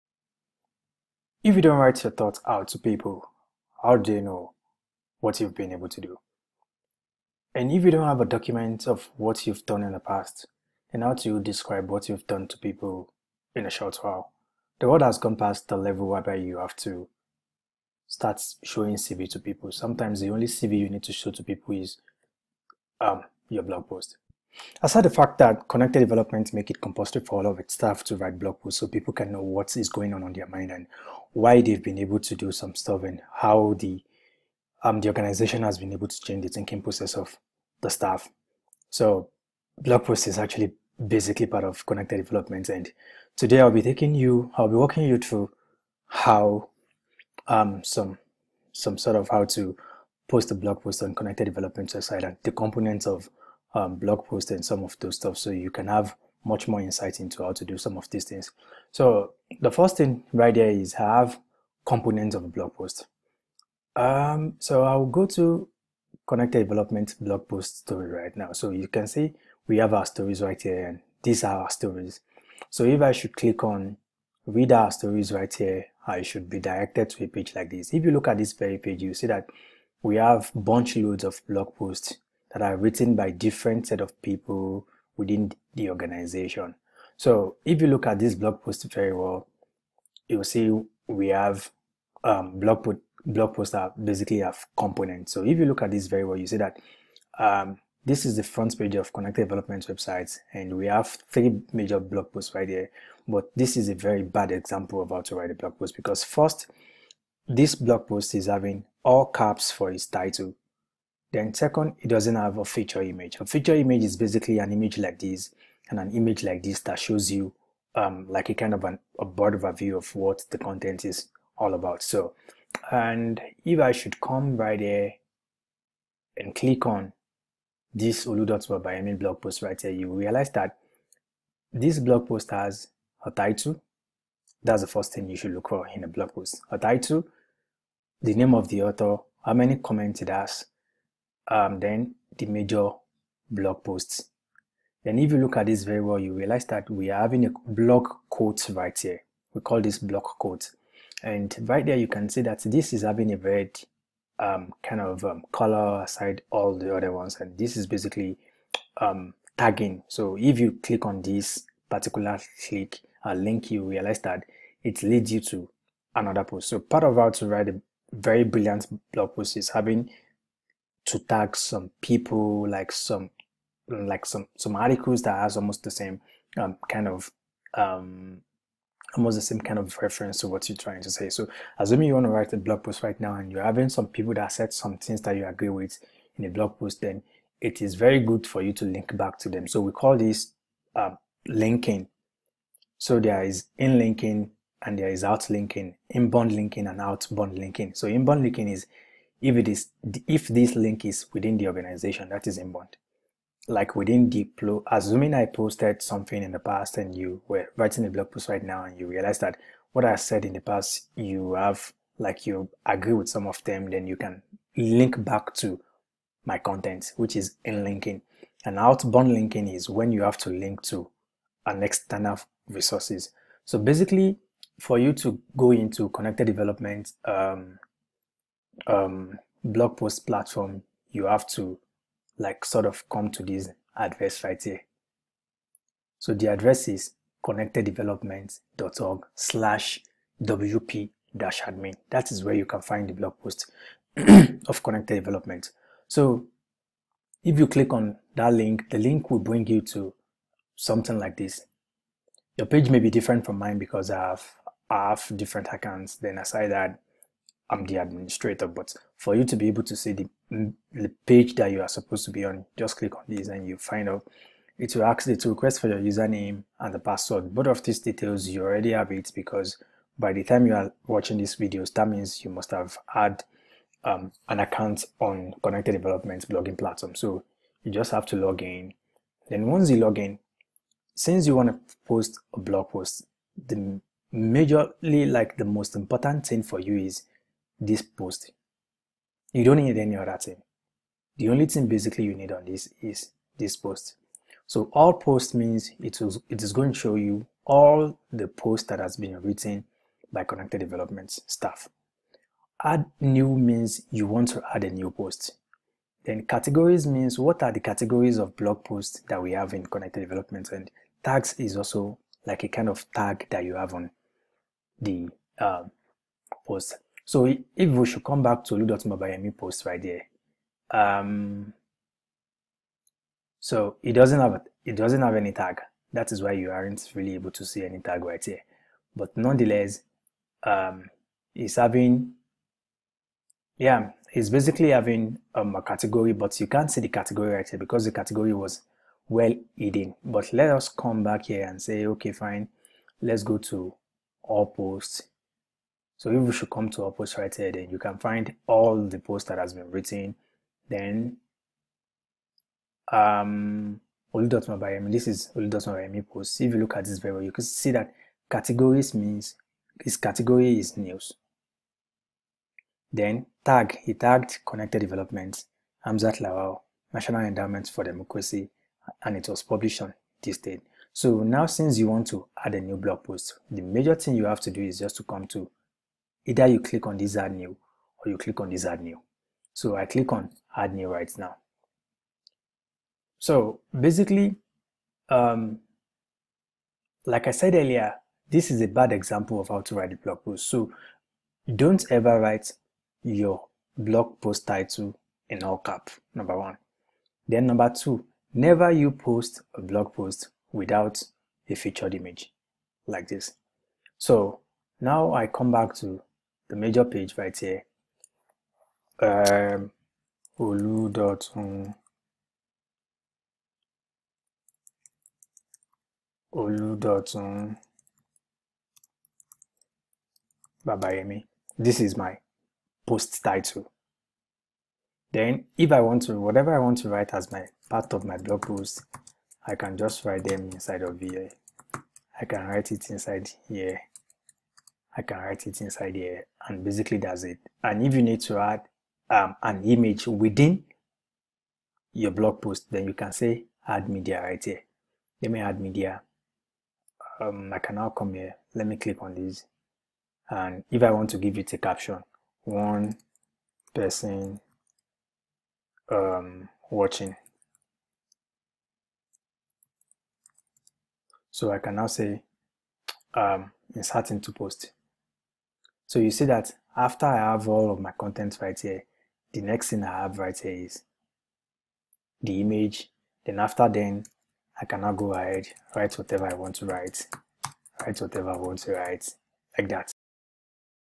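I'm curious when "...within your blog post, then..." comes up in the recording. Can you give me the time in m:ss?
7:20.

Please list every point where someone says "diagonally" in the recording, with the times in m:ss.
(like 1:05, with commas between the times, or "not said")
not said.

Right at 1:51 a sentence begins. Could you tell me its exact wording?
Then second, it doesn't have a feature image.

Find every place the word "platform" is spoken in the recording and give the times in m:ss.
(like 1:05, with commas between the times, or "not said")
3:50, 4:36.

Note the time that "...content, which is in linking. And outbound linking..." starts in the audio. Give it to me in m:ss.
3:36.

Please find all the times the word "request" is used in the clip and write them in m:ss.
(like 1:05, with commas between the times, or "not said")
4:25.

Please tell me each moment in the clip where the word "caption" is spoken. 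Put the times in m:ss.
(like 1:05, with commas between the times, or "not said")
7:31.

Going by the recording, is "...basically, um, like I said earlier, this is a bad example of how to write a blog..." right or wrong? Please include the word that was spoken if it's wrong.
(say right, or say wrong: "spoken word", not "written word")
right.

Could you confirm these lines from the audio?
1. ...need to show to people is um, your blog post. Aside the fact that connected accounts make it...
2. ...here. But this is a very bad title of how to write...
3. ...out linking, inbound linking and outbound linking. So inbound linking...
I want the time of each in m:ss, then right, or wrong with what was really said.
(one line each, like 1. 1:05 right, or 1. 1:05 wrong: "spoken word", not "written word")
1. 0:20 wrong: "developments", not "accounts"
2. 1:42 wrong: "example", not "title"
3. 3:15 right.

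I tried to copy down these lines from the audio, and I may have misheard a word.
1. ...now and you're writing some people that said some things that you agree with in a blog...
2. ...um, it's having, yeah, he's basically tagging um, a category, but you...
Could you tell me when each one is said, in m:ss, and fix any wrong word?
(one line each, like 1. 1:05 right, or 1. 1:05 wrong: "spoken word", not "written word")
1. 3:03 wrong: "having", not "writing"
2. 5:30 wrong: "having", not "tagging".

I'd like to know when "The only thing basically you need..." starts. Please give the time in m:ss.
4:51.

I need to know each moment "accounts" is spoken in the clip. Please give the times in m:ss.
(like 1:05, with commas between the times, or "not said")
4:15, 4:34.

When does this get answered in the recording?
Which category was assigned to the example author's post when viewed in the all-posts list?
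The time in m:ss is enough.
6:00.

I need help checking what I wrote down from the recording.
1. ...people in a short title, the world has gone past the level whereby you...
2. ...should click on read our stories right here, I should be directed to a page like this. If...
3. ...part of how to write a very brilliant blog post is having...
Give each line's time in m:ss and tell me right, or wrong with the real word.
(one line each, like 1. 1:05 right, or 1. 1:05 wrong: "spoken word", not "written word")
1. 0:12 wrong: "while", not "title"
2. 1:13 right
3. 2:46 right.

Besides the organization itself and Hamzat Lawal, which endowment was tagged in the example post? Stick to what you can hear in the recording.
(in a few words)
National Endowment for Democracy.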